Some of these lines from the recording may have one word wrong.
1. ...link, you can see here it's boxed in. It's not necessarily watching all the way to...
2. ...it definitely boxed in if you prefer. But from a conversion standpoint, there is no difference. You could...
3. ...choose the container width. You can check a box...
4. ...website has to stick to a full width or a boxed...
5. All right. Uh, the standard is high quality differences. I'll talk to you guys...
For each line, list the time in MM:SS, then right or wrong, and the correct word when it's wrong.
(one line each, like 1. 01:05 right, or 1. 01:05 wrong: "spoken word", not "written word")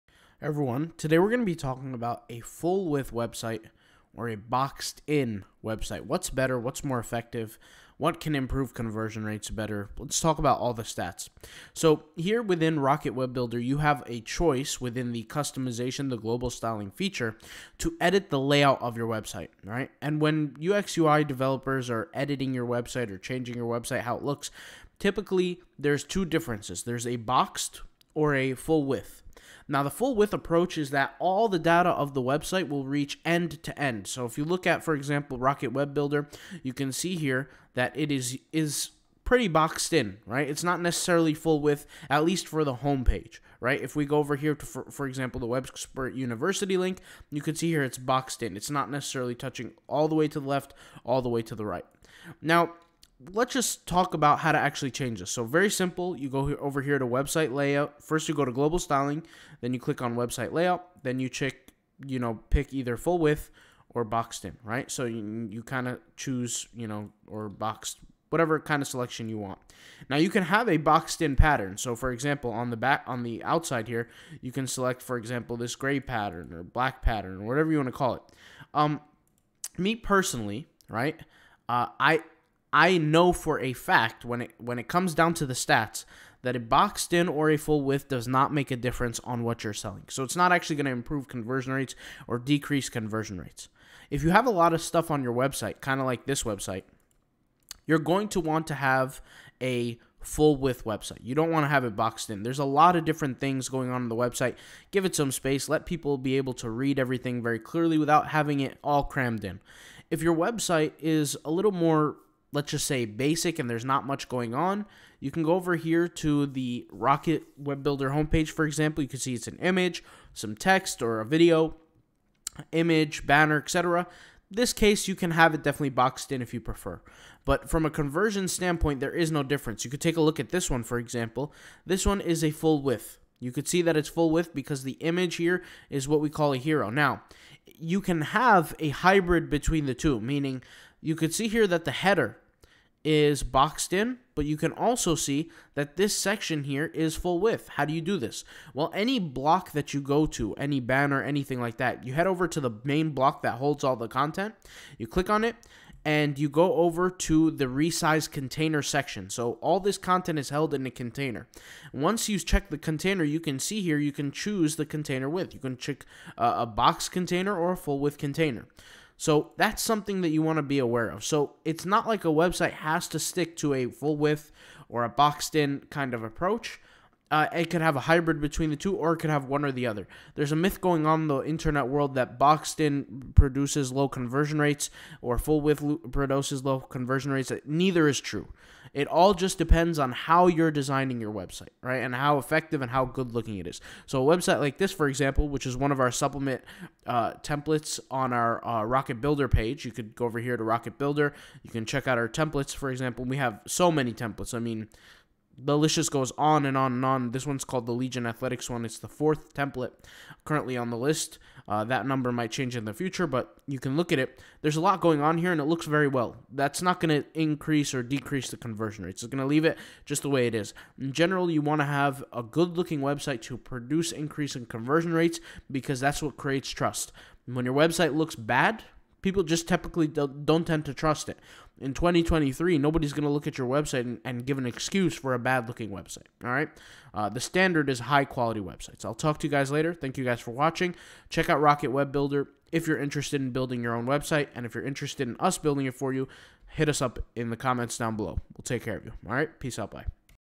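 1. 00:46 wrong: "touching", not "watching"
2. 02:05 right
3. 02:44 right
4. 02:52 right
5. 03:56 wrong: "websites", not "differences".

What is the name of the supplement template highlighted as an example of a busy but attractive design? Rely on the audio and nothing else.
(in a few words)
Legion Athletics.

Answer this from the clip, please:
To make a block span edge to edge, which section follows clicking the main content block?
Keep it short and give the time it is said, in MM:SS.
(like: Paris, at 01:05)
resize container, at 02:37.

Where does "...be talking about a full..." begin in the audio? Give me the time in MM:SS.
00:01.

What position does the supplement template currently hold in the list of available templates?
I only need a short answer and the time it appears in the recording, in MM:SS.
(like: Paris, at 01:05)
fourth, at 03:29.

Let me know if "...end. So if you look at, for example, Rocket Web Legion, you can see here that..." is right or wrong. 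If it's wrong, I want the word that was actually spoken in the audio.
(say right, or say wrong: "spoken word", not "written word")
wrong: "Builder", not "Legion".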